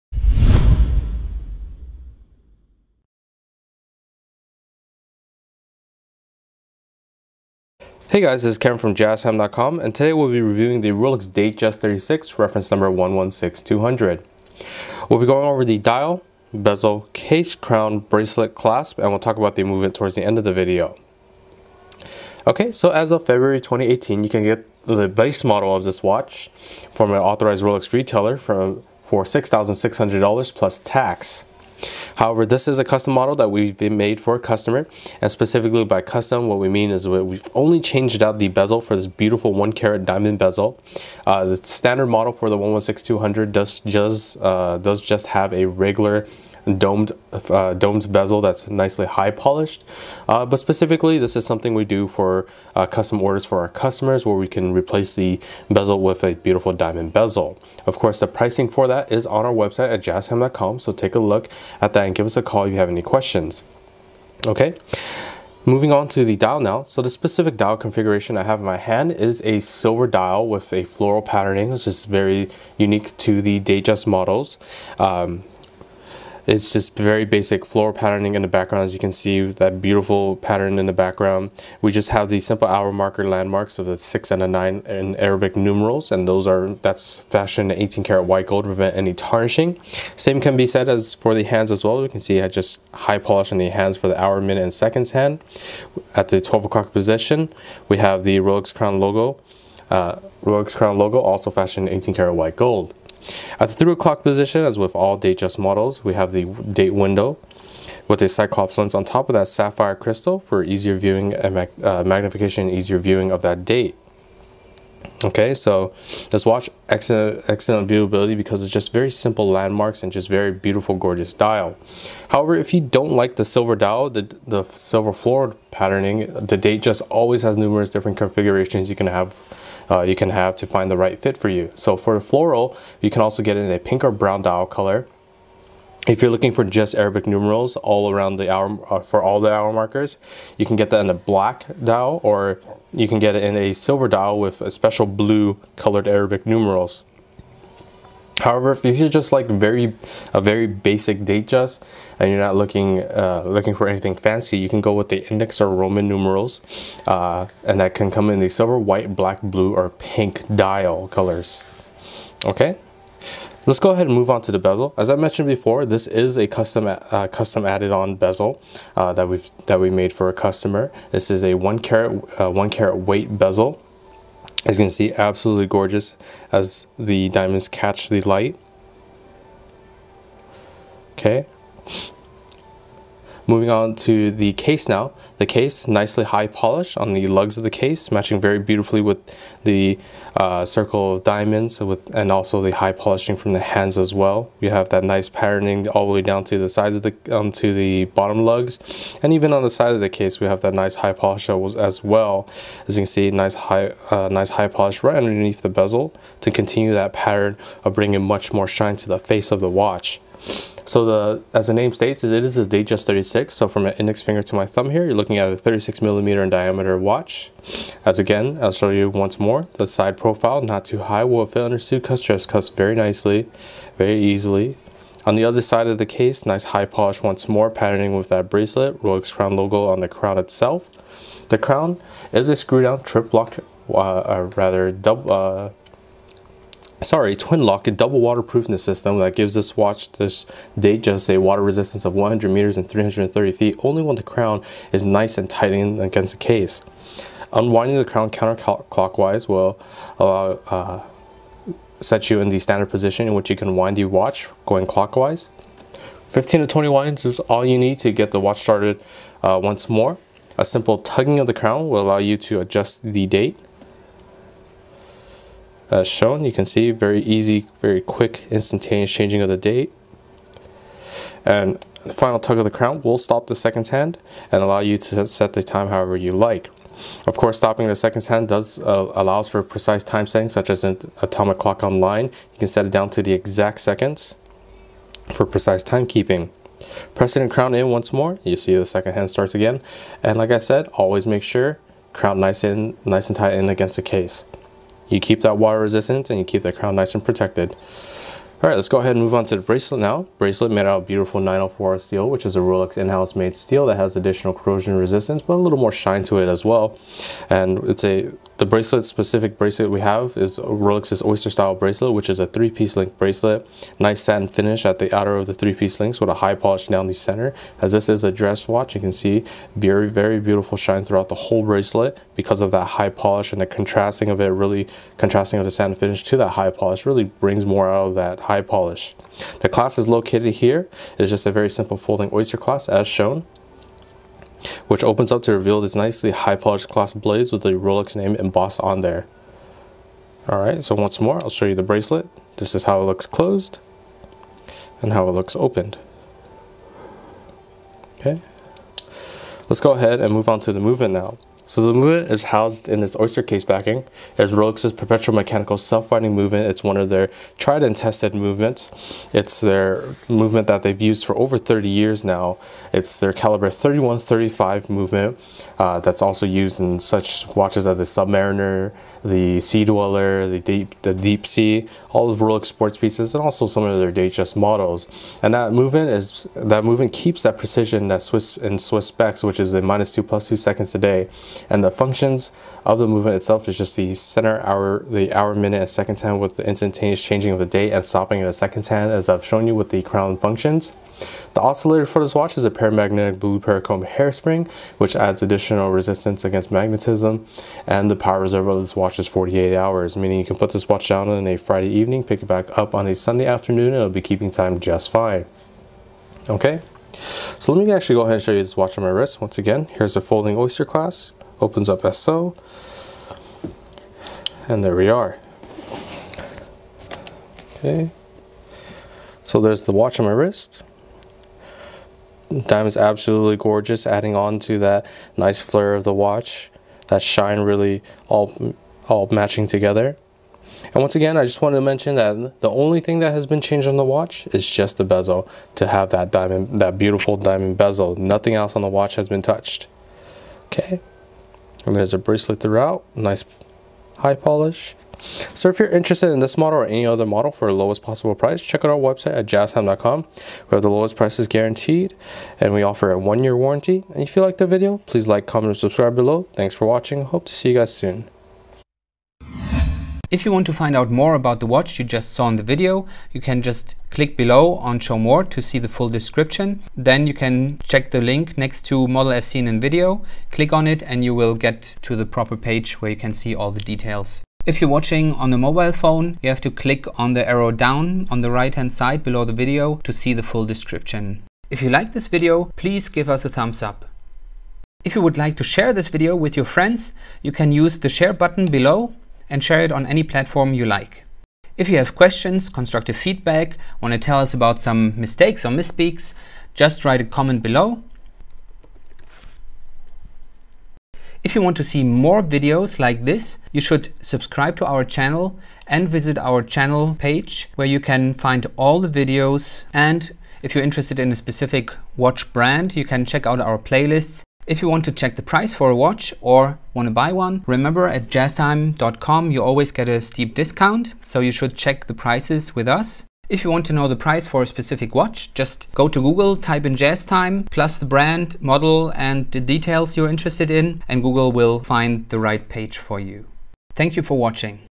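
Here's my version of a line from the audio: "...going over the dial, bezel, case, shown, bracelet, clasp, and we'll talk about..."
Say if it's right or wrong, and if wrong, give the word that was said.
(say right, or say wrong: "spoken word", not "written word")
wrong: "crown", not "shown".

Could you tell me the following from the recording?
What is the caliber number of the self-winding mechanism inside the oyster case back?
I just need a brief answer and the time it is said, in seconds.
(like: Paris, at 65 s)
3135, at 363 s.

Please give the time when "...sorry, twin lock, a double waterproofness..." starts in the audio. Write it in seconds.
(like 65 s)
237 s.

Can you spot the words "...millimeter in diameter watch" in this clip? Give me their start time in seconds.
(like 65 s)
216 s.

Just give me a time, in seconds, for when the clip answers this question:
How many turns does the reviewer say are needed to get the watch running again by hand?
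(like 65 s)
256 s.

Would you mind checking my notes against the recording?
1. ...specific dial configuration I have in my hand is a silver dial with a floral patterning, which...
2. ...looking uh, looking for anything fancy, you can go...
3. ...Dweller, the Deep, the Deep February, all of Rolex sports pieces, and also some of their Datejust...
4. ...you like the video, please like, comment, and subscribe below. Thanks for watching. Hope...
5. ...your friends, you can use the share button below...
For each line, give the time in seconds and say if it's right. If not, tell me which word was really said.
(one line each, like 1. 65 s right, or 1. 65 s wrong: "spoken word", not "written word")
1. 67 s right
2. 152 s right
3. 369 s wrong: "Sea", not "February"
4. 454 s right
5. 486 s right.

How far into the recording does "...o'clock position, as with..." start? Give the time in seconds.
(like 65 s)
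103 s.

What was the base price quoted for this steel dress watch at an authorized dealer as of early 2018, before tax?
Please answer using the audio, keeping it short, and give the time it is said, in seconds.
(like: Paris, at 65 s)
$6,600, at 29 s.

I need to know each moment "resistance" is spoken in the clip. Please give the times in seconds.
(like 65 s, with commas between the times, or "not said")
241 s, 295 s, 304 s, 395 s.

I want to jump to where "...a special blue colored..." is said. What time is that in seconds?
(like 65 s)
144 s.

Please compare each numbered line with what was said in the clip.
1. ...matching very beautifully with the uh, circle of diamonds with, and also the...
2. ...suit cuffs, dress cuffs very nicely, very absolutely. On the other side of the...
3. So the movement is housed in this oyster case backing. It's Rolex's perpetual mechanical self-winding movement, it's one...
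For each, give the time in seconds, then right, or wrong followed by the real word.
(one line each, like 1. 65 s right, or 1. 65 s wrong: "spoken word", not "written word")
1. 188 s right
2. 221 s wrong: "easily", not "absolutely"
3. 351 s right.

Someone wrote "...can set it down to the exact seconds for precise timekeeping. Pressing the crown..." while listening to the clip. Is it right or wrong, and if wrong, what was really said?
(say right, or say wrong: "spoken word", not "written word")
right.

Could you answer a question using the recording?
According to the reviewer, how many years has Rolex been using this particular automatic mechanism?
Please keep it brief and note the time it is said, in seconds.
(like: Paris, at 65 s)
over 30 years, at 361 s.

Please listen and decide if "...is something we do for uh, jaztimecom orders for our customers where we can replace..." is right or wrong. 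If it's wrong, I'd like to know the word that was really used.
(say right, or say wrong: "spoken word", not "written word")
wrong: "custom", not "jaztimecom".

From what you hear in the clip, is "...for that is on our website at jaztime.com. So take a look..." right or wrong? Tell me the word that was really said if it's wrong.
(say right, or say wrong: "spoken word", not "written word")
right.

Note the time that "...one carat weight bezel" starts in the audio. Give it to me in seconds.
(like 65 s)
172 s.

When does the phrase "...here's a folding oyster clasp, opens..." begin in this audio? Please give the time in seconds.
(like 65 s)
409 s.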